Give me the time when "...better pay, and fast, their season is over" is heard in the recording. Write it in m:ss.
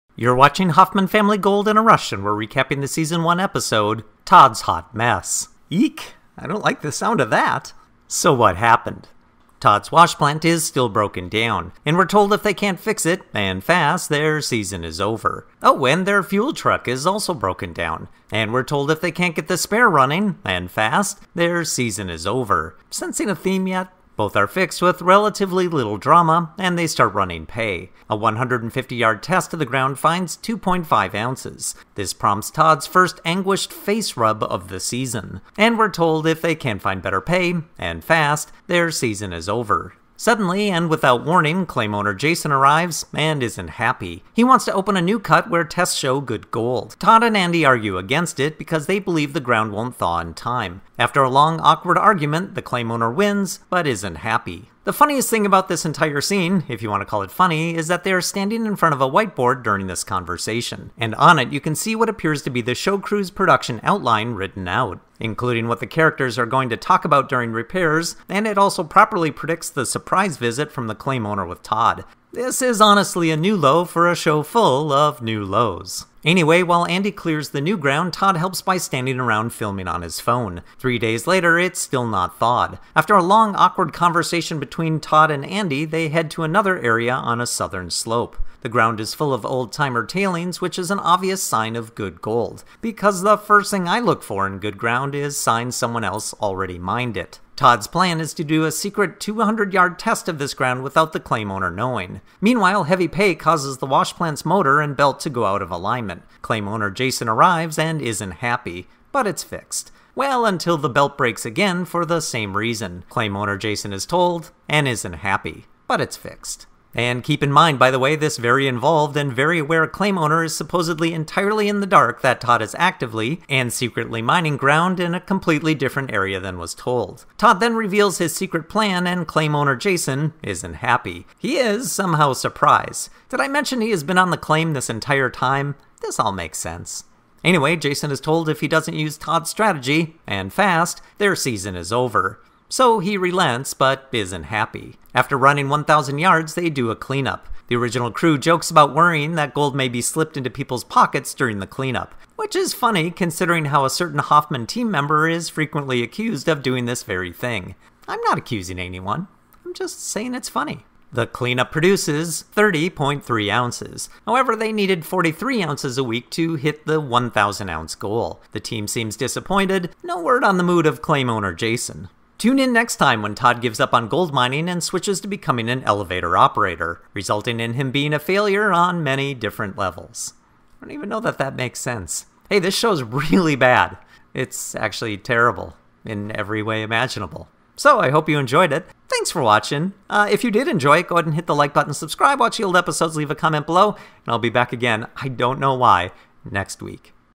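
0:37.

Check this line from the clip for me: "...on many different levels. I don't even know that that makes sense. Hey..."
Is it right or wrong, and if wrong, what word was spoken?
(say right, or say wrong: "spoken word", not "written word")
right.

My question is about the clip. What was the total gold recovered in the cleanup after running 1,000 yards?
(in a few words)
30.3 ounces.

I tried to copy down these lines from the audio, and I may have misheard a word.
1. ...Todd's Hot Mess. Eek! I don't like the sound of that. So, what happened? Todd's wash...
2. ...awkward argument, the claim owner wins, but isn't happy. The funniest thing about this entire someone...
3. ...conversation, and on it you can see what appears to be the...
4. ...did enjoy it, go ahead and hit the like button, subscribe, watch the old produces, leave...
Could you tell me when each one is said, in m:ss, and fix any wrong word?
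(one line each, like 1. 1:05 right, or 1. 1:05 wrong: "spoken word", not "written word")
1. 0:04 right
2. 0:51 wrong: "scene", not "someone"
3. 1:00 right
4. 3:10 wrong: "episodes", not "produces".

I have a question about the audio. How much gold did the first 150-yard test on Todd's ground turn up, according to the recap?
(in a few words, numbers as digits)
2.5 ounces.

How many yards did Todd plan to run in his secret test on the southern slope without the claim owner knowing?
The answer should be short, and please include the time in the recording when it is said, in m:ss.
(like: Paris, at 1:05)
200, at 1:39.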